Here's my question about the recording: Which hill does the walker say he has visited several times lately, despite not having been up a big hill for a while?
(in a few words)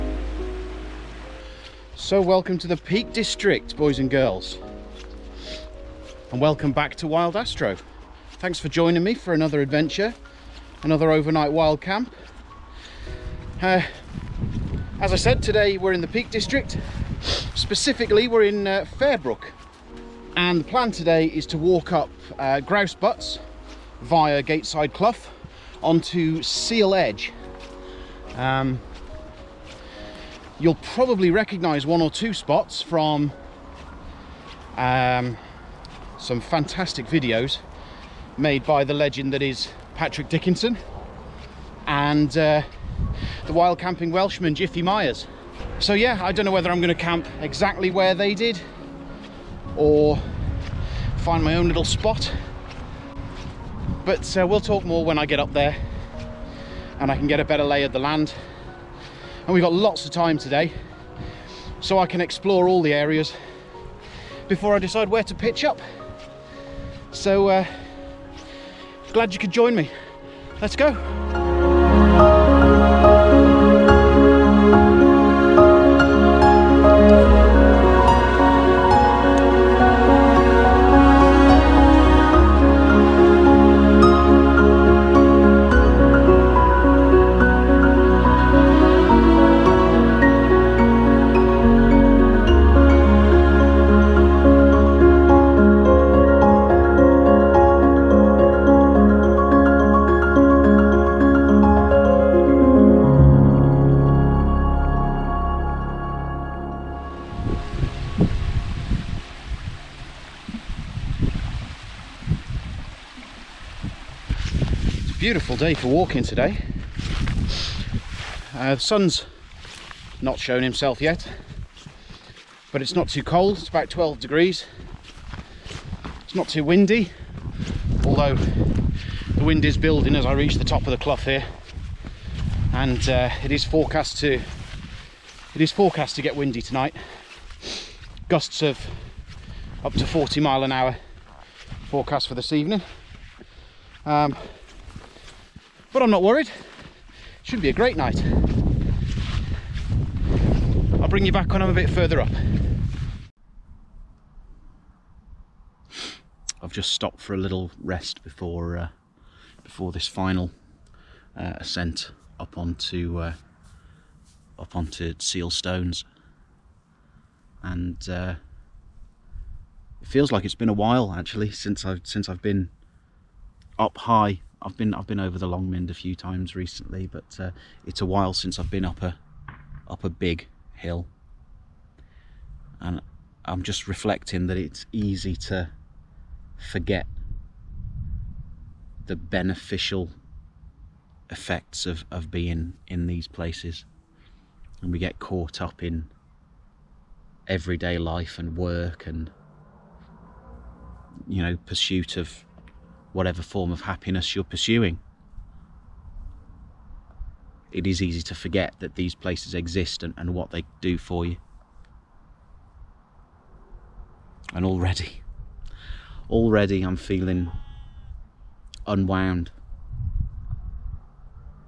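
Long Mynd.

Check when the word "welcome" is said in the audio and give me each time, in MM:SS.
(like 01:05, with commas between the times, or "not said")
00:02, 00:06.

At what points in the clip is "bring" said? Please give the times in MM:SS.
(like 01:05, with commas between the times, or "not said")
02:31.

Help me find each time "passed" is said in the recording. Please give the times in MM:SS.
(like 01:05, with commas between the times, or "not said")
not said.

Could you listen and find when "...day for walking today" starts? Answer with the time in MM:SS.
01:55.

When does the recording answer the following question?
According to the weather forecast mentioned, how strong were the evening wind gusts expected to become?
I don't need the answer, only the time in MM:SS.
02:20.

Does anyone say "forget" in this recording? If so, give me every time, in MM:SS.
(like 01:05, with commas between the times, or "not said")
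03:06, 03:28.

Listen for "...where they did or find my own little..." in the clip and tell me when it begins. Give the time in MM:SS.
00:47.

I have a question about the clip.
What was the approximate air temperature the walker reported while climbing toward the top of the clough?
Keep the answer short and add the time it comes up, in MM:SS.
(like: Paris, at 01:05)
12 degrees, at 02:03.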